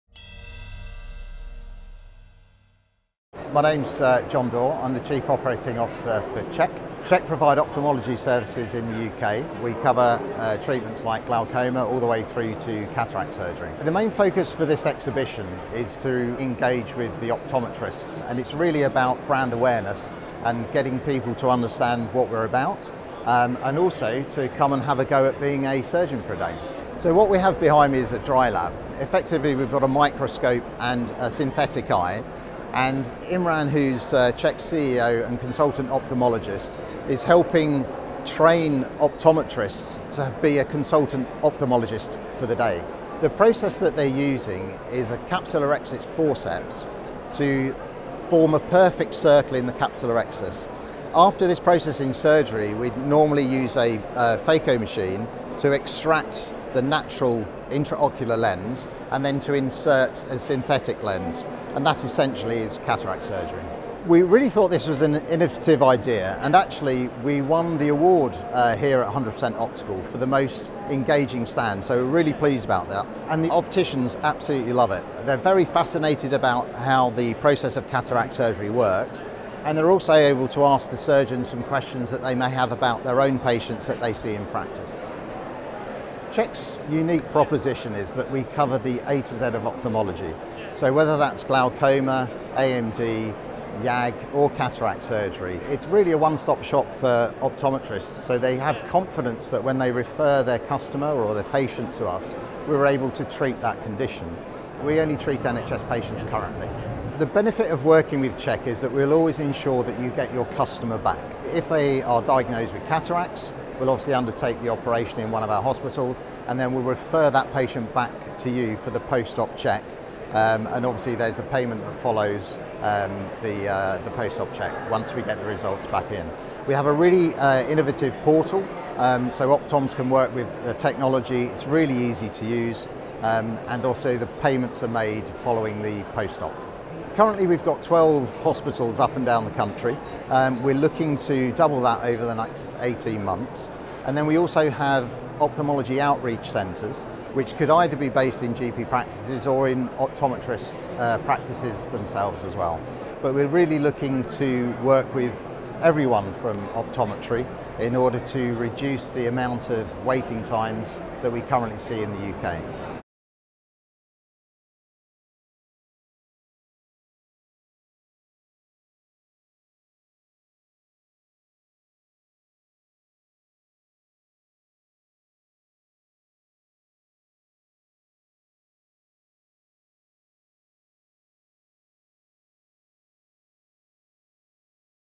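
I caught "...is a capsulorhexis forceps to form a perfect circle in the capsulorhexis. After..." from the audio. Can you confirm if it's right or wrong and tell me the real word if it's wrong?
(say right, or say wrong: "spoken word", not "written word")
right.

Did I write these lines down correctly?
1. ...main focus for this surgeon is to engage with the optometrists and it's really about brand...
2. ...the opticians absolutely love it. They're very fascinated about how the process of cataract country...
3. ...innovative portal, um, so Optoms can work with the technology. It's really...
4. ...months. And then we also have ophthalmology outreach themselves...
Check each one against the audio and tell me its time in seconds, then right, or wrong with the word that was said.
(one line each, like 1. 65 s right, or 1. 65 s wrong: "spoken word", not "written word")
1. 13 s wrong: "exhibition", not "surgeon"
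2. 73 s wrong: "surgery", not "country"
3. 127 s right
4. 143 s wrong: "centres", not "themselves".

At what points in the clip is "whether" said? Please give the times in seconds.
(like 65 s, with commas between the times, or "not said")
90 s.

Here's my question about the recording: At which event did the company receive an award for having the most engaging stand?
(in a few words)
100% Optical.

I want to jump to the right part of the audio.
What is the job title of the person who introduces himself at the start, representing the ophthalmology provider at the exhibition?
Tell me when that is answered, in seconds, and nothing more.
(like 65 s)
5 s.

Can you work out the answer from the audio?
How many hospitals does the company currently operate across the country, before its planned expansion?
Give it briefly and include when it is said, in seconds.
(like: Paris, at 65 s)
12, at 137 s.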